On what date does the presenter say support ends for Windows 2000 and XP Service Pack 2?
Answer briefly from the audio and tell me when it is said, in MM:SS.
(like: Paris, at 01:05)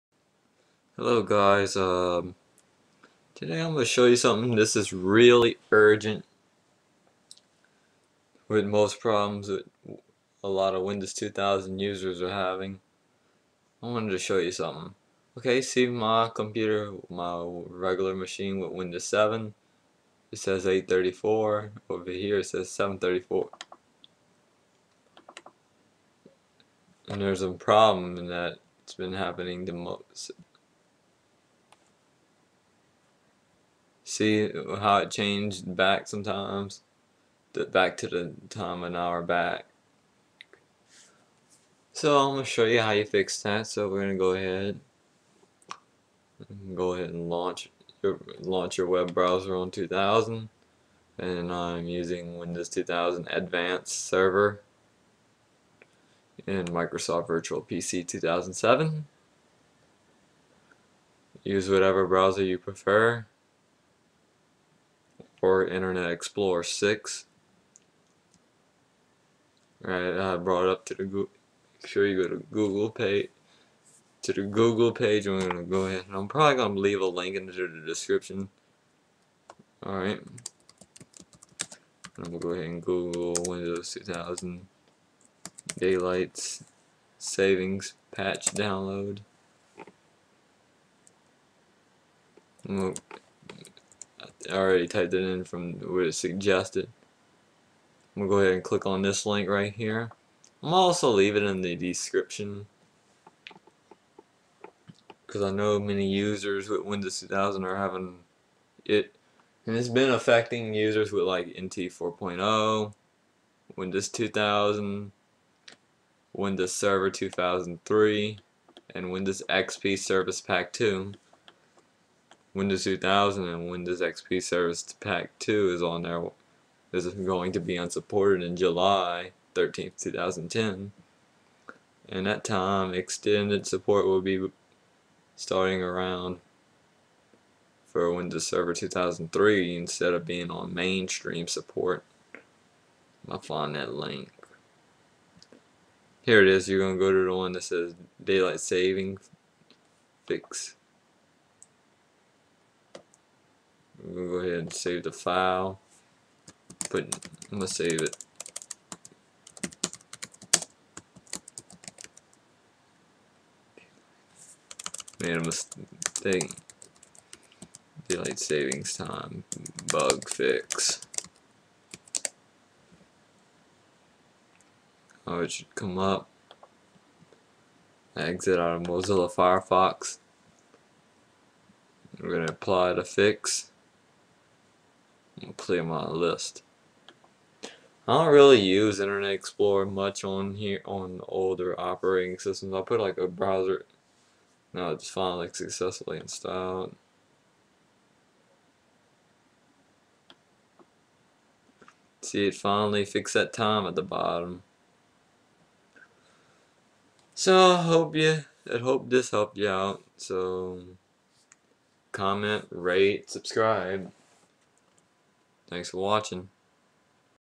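July 13th 2010, at 02:08.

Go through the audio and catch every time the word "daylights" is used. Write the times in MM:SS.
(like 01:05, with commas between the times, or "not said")
01:25, 02:28, 02:48.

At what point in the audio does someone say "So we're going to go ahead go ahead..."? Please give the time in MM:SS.
00:43.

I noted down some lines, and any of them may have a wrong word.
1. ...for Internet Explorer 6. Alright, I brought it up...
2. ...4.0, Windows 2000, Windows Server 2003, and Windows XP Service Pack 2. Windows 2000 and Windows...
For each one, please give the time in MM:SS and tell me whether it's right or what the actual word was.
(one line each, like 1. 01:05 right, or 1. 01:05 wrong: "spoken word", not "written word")
1. 01:05 right
2. 01:51 right.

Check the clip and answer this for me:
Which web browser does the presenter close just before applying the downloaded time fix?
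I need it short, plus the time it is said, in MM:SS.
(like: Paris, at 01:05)
Mozilla Firefox, at 02:58.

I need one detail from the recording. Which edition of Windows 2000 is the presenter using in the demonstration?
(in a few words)
Advanced Server.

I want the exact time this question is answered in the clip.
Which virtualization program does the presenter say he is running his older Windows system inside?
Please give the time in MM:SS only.
00:56.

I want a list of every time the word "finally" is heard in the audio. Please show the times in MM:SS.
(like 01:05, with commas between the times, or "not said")
03:15, 03:22.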